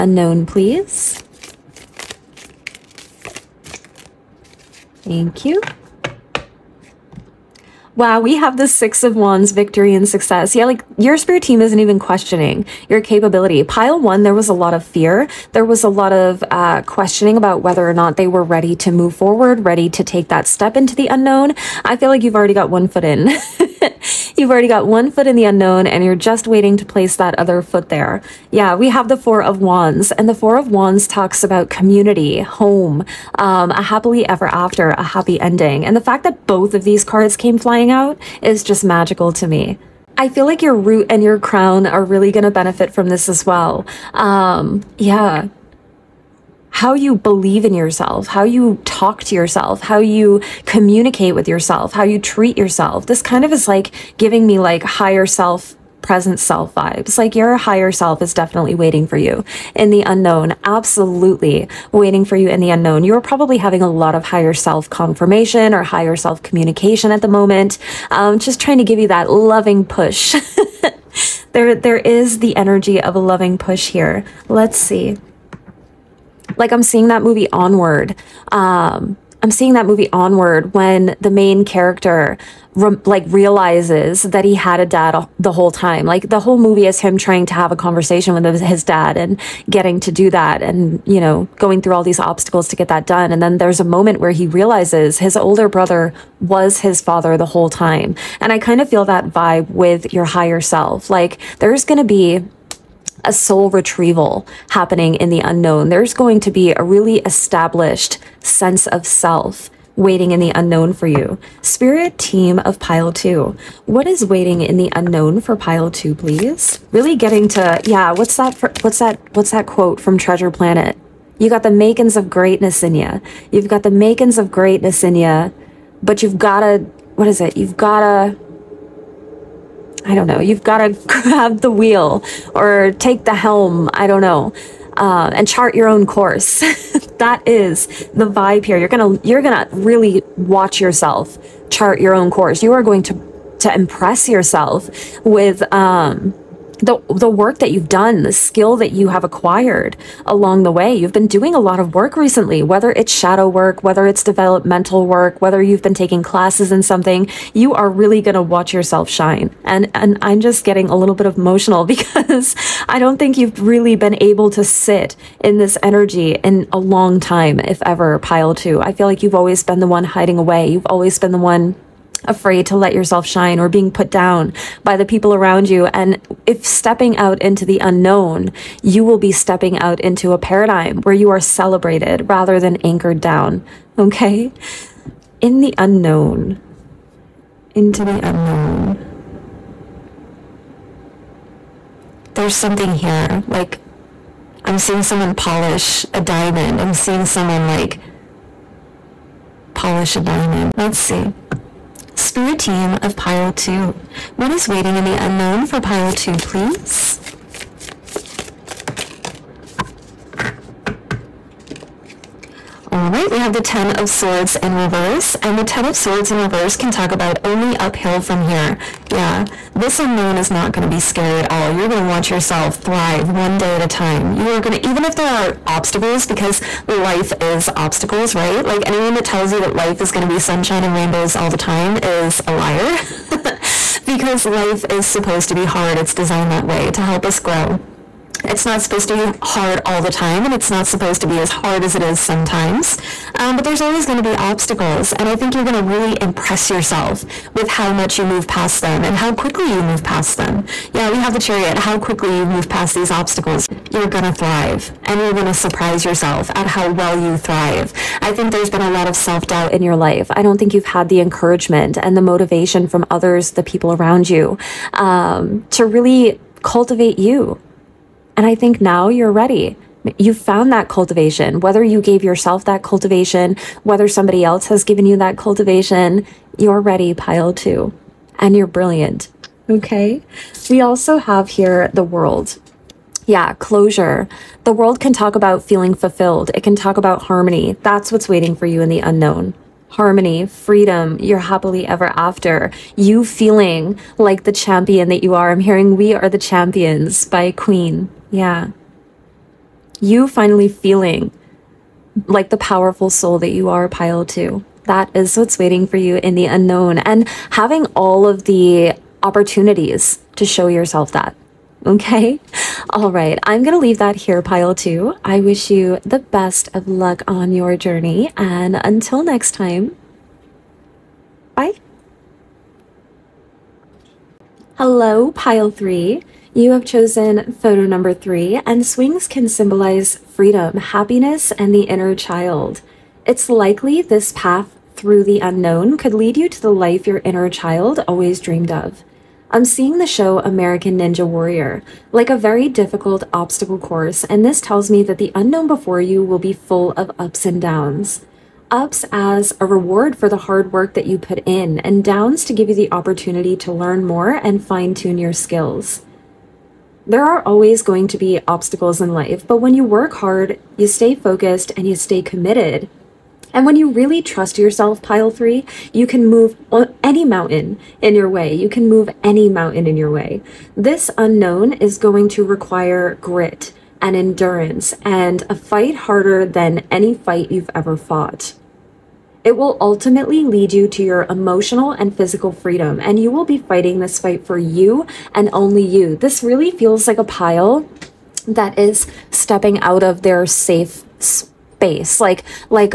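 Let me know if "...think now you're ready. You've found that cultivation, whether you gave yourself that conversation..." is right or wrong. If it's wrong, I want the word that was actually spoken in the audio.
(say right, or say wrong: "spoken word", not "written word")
wrong: "cultivation", not "conversation".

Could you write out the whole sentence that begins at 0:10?
Yeah, like your spirit team isn't even questioning your capability.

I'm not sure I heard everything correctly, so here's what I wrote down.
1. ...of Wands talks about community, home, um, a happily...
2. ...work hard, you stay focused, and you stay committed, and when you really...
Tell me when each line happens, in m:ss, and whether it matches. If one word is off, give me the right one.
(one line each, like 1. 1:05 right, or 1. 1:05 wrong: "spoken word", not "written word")
1. 0:30 right
2. 5:59 right.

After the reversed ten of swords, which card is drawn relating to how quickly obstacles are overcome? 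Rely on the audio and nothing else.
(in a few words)
the chariot.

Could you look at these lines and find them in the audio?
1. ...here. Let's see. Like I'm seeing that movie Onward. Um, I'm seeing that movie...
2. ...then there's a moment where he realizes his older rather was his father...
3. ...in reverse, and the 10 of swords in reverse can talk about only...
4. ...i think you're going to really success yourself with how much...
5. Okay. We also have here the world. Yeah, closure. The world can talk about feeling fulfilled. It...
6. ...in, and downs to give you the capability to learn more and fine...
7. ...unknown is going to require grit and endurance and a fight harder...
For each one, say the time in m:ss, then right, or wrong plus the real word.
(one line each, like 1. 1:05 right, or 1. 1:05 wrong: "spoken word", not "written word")
1. 1:13 right
2. 1:33 wrong: "brother", not "rather"
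3. 3:34 right
4. 4:05 wrong: "impress", not "success"
5. 4:39 right
6. 5:51 wrong: "opportunity", not "capability"
7. 6:11 right.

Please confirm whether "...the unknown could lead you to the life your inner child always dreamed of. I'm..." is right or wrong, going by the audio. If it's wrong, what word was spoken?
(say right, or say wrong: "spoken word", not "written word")
right.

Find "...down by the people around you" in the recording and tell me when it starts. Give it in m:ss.
2:54.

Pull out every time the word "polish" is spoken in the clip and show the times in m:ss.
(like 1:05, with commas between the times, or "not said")
3:15, 3:19.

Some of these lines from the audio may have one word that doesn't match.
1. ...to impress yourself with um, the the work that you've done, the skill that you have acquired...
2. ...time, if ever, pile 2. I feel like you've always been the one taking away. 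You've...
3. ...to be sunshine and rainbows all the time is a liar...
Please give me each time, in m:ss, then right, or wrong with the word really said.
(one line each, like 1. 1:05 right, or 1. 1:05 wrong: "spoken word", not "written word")
1. 2:23 right
2. 2:47 wrong: "hiding", not "taking"
3. 3:50 right.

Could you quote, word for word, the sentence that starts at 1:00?
Absolutely waiting for you in the unknown.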